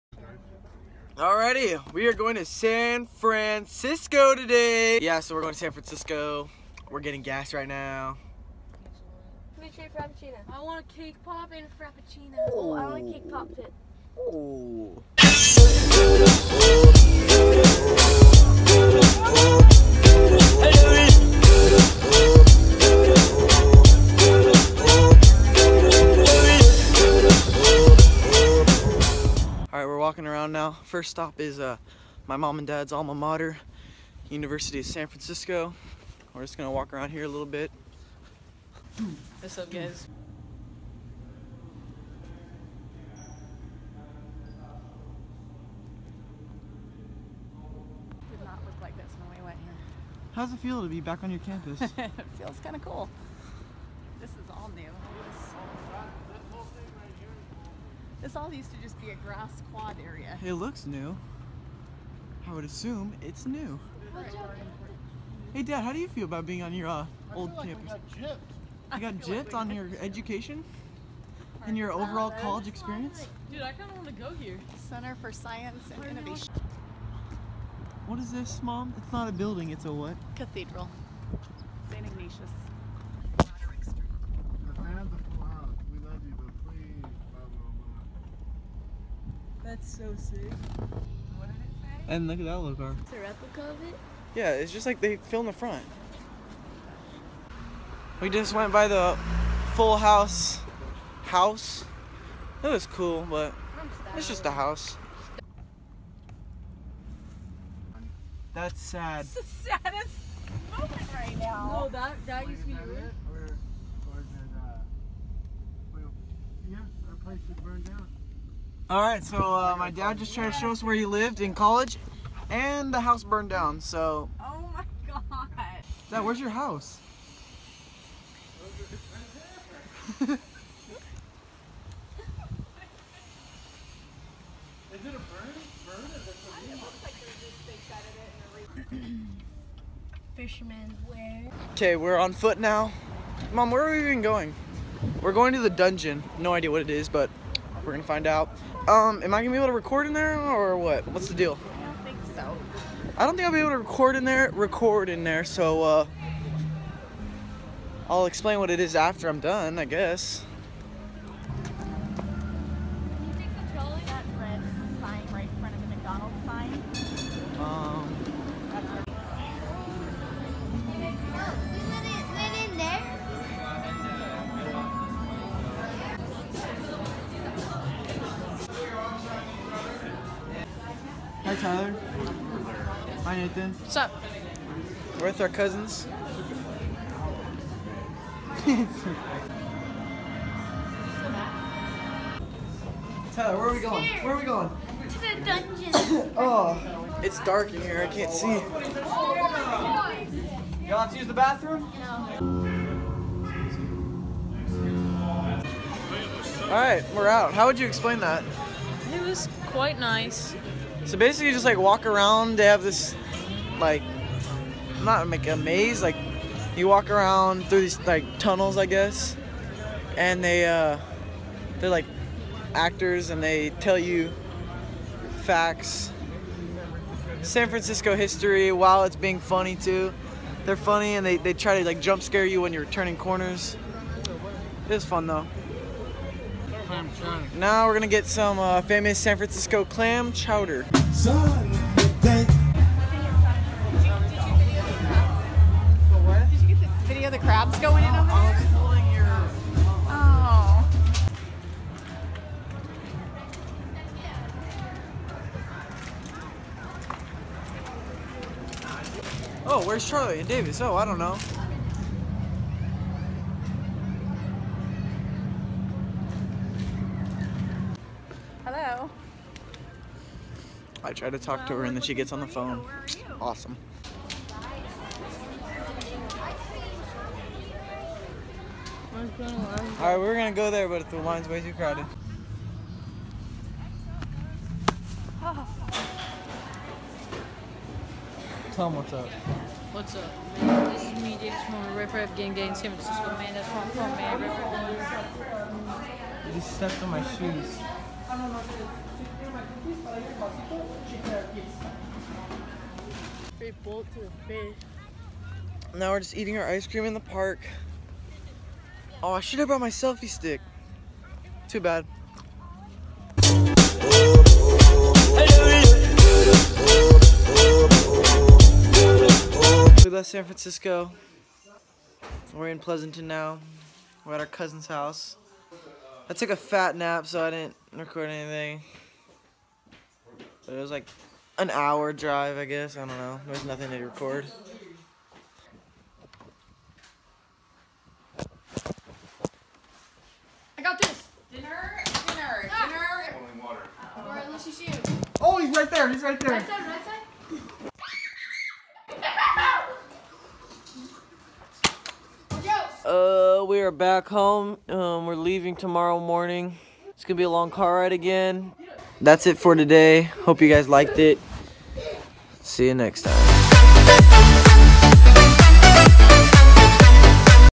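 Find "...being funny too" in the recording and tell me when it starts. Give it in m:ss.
3:49.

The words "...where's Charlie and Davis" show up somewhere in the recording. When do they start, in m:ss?
4:19.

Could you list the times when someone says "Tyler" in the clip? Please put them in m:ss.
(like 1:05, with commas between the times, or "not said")
3:01, 3:13.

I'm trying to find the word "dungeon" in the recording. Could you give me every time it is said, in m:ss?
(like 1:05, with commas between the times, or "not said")
2:25, 3:15.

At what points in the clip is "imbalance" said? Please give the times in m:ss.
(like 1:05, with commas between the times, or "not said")
not said.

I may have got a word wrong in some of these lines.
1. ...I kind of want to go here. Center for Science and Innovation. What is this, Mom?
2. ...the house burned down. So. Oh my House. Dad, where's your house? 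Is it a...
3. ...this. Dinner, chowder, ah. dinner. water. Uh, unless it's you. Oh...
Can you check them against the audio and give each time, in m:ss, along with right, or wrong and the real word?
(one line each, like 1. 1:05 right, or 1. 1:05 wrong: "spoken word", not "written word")
1. 1:13 right
2. 2:02 wrong: "God", not "House"
3. 5:40 wrong: "dinner", not "chowder".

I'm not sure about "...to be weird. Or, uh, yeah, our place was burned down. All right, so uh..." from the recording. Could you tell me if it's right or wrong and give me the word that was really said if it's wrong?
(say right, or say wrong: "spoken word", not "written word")
right.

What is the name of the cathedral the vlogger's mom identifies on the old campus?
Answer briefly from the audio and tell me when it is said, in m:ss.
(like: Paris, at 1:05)
St. Ignatius, at 1:21.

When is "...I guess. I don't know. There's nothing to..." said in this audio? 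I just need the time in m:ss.
5:32.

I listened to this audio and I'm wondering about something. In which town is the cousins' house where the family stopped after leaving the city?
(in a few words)
Pleasanton.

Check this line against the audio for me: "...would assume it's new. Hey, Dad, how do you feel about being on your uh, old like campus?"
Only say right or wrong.
right.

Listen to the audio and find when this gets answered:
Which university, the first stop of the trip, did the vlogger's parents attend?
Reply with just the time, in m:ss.
0:34.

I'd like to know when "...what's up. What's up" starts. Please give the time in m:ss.
4:48.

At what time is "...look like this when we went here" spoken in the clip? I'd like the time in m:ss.
0:48.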